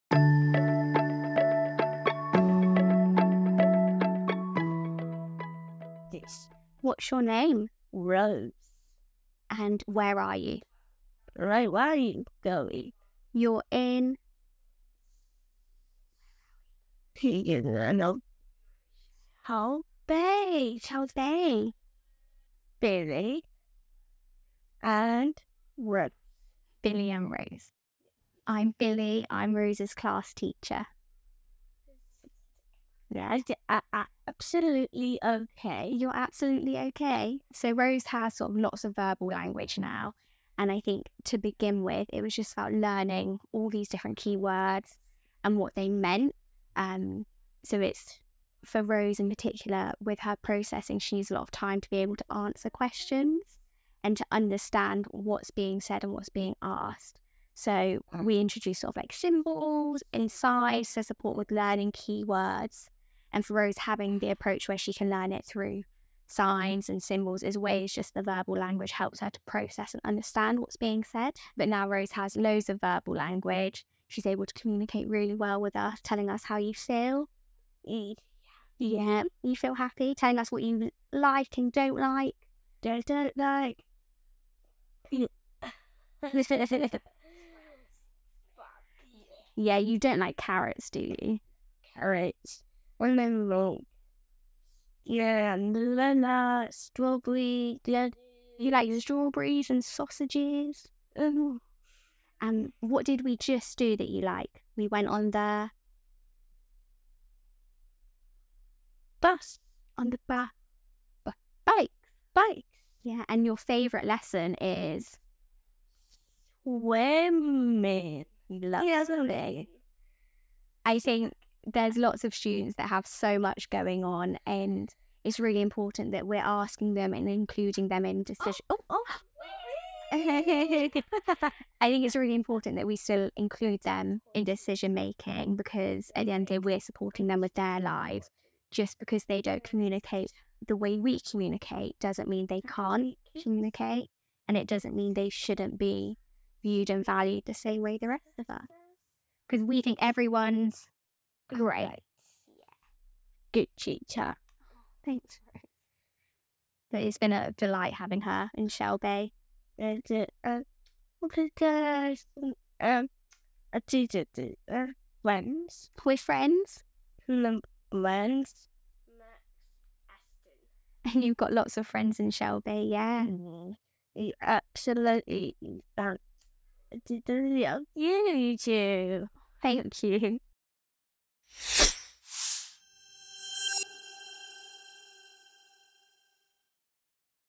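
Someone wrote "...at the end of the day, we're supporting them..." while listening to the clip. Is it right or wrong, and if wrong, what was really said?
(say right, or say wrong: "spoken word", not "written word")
right.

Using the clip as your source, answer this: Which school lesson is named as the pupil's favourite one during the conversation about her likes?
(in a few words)
Swimming.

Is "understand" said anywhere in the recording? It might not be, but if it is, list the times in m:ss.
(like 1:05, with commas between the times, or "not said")
0:54, 1:10.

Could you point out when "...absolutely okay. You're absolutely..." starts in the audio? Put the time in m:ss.
0:34.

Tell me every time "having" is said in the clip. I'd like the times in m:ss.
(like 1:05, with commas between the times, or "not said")
1:03, 2:37.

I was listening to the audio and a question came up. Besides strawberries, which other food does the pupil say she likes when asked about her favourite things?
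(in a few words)
Sausages.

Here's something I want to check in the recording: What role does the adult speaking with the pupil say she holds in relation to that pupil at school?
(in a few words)
Class teacher.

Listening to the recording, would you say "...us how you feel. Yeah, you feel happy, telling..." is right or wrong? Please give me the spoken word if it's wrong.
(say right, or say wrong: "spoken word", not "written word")
right.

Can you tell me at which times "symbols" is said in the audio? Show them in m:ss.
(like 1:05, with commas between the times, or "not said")
0:59, 1:07.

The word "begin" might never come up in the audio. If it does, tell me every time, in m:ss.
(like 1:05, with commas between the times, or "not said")
0:41.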